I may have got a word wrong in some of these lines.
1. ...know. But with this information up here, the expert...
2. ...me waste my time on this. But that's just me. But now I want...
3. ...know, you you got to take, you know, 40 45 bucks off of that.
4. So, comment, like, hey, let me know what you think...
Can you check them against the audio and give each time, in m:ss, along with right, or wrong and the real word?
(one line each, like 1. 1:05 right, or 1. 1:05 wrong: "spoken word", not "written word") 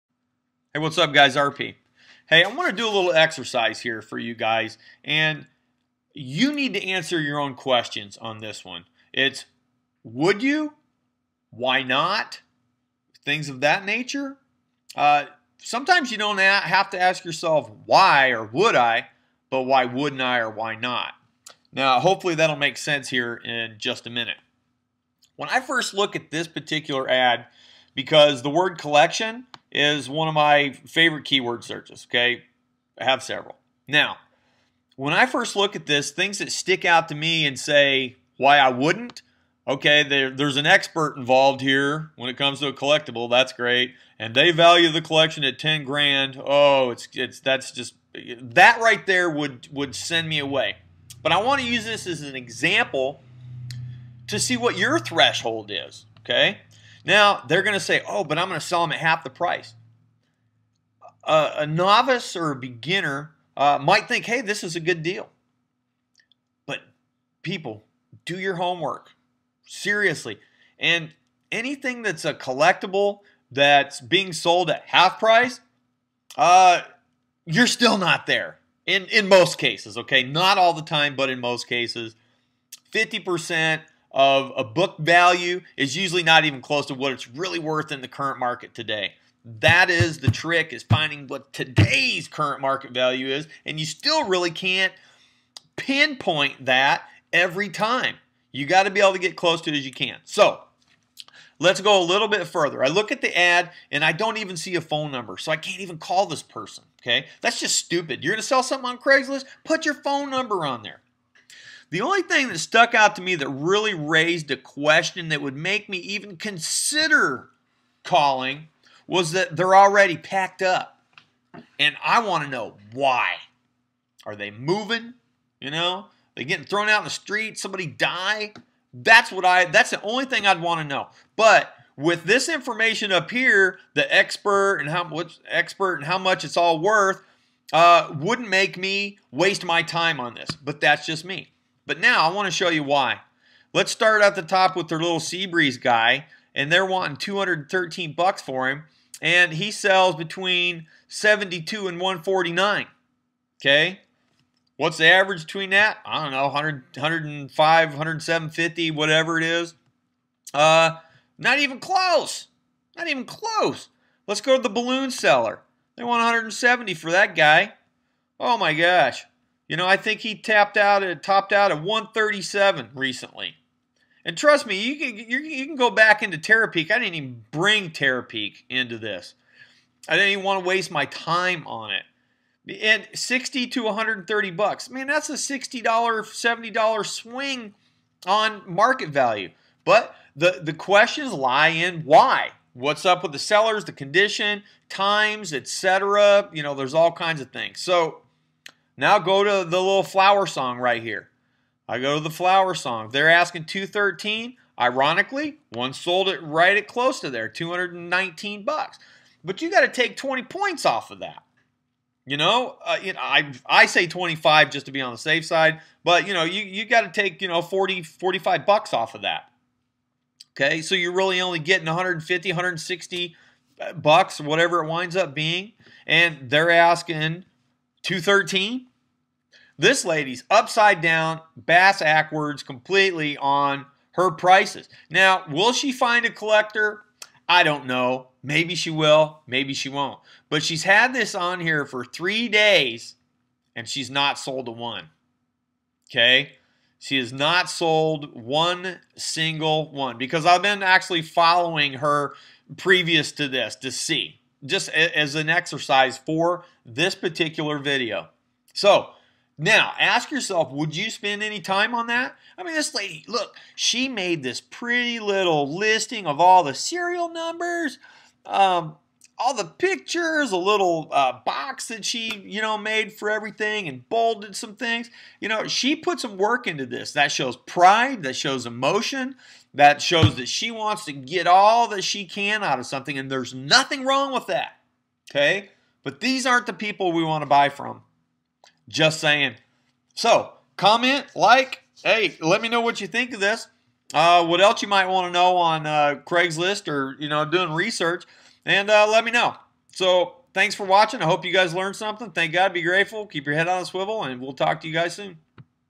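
1. 2:10 right
2. 2:18 right
3. 3:36 right
4. 4:50 right.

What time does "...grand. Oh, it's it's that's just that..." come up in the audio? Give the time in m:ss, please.
0:45.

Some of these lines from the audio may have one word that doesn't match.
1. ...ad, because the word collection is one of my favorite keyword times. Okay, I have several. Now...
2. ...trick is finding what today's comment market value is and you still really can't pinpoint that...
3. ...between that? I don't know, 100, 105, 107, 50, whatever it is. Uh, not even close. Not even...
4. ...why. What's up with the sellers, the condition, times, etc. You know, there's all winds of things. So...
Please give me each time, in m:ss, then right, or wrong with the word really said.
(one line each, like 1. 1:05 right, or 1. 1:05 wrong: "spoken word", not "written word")
1. 0:27 wrong: "searches", not "times"
2. 1:30 wrong: "current", not "comment"
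3. 2:35 right
4. 3:12 wrong: "kinds", not "winds".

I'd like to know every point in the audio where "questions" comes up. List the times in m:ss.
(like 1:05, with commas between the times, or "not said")
0:07, 1:54, 3:10.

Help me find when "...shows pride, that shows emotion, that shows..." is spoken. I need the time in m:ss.
4:37.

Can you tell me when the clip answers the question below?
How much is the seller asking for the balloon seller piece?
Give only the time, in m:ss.
2:46.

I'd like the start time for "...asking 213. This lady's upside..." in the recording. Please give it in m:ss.
3:46.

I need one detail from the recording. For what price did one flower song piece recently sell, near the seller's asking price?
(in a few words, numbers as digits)
$219.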